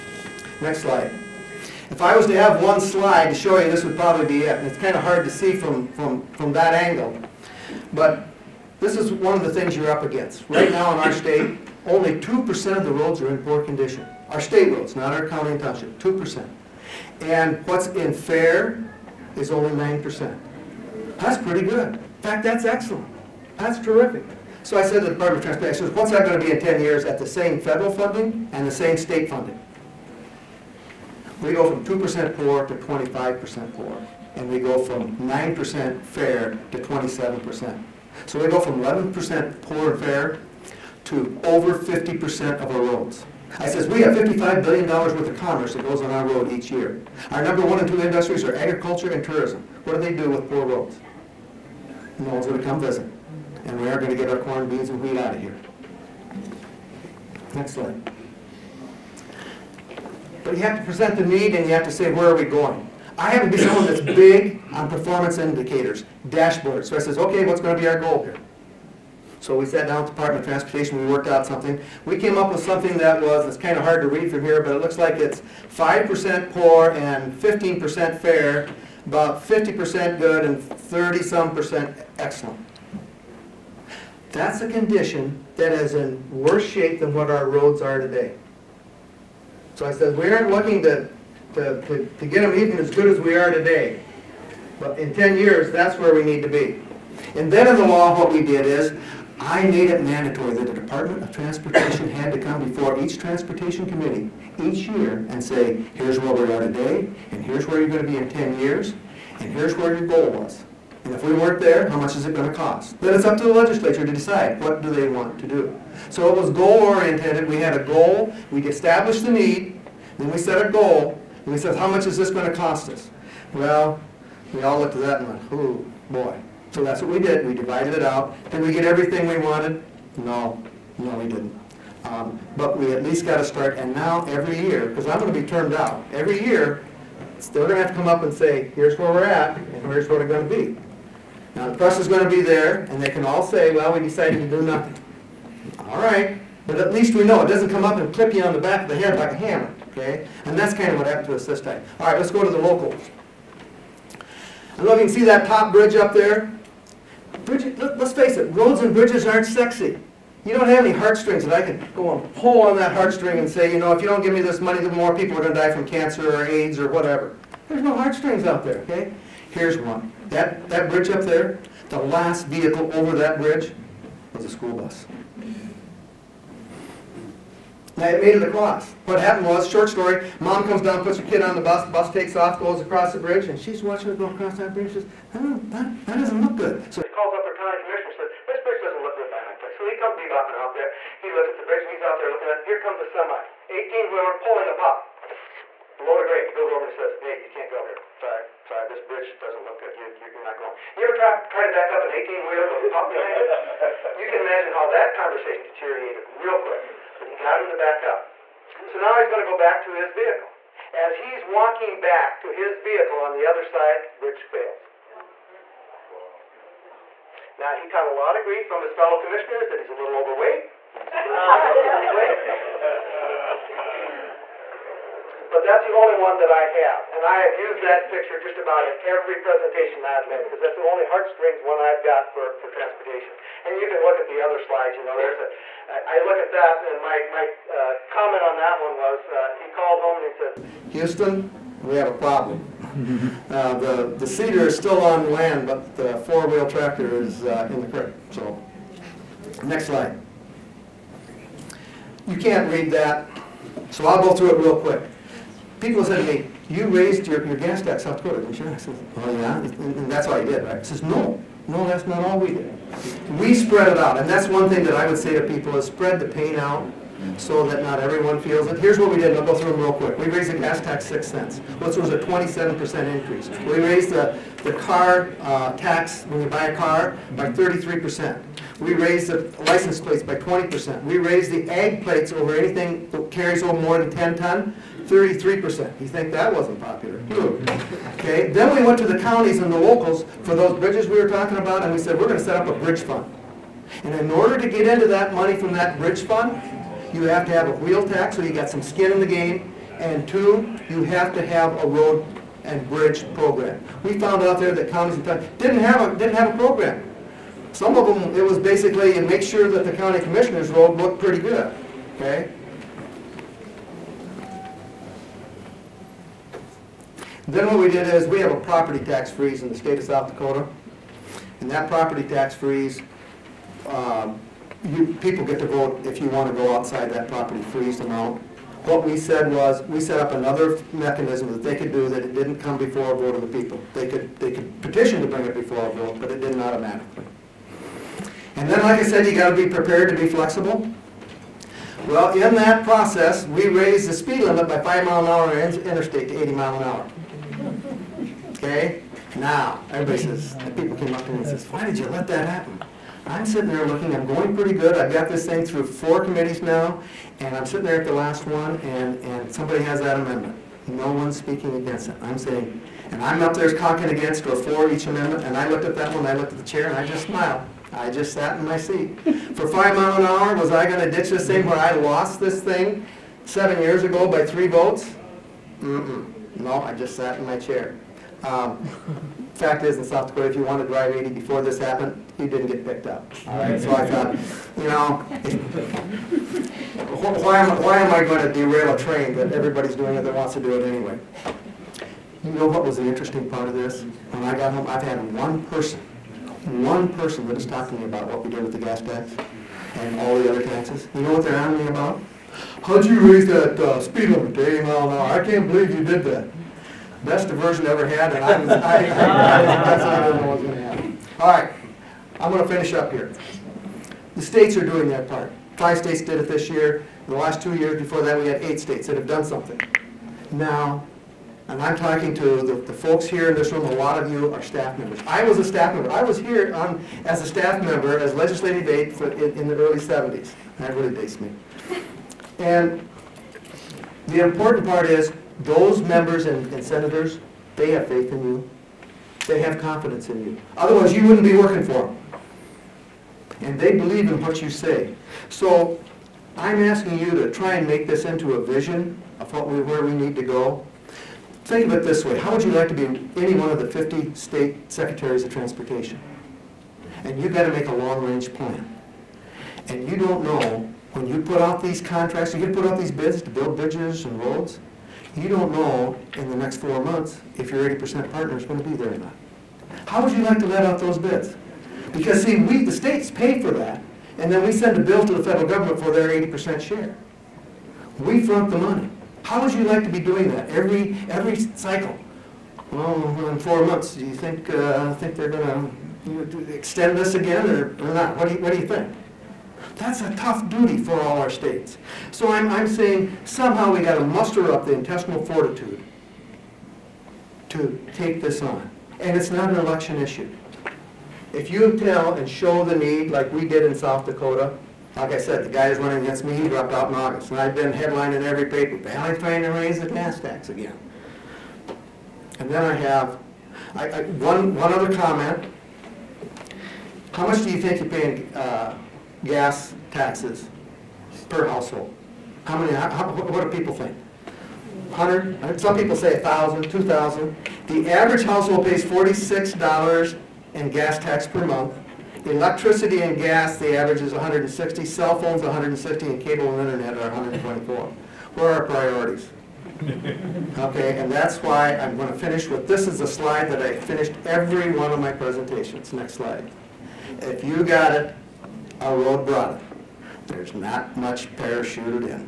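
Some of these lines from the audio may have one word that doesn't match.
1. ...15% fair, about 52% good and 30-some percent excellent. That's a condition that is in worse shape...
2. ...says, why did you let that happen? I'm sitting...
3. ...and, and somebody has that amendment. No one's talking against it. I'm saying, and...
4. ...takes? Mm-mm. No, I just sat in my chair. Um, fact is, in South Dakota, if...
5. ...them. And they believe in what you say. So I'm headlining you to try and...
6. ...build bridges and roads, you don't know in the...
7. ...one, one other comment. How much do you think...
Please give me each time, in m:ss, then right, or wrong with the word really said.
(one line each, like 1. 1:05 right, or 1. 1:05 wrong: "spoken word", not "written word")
1. 1:17 wrong: "50", not "52"
2. 5:51 right
3. 5:58 wrong: "speaking", not "talking"
4. 6:14 wrong: "votes", not "takes"
5. 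7:22 wrong: "asking", not "headlining"
6. 7:43 right
7. 8:34 right.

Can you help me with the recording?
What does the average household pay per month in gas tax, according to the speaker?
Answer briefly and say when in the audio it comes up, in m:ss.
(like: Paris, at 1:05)
$46, at 8:49.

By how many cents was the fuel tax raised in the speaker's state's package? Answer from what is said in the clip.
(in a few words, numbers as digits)
6 cents.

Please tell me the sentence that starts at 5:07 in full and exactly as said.
Some of them, it was basically, and make sure that the county commissioner's road looked pretty good.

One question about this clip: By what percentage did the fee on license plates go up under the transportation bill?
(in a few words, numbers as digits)
20%.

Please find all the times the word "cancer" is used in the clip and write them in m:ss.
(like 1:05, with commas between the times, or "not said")
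2:45.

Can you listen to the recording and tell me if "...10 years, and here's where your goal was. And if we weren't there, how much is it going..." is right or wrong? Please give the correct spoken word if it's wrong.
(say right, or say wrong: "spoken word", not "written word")
right.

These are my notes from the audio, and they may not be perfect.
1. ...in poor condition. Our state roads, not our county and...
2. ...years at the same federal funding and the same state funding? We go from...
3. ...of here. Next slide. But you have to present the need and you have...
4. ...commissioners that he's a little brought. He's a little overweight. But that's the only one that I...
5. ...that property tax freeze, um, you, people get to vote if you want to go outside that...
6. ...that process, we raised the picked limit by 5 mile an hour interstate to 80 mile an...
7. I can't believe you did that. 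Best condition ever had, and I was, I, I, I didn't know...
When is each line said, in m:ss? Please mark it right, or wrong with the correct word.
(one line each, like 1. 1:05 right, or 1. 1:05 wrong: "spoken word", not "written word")
1. 0:13 right
2. 0:26 right
3. 0:55 right
4. 3:39 wrong: "overweight", not "brought"
5. 5:21 right
6. 5:42 wrong: "speed", not "picked"
7. 6:45 wrong: "diversion", not "condition".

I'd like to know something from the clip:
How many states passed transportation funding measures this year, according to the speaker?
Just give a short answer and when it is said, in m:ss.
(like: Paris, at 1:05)
5, at 6:55.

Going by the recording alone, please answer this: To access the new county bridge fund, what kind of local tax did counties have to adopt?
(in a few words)
A wheel tax.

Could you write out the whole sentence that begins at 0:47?
Our number one and two industries are agriculture and tourism.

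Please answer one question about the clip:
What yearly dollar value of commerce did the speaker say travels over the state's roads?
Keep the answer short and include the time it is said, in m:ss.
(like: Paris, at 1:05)
$55 billion, at 0:44.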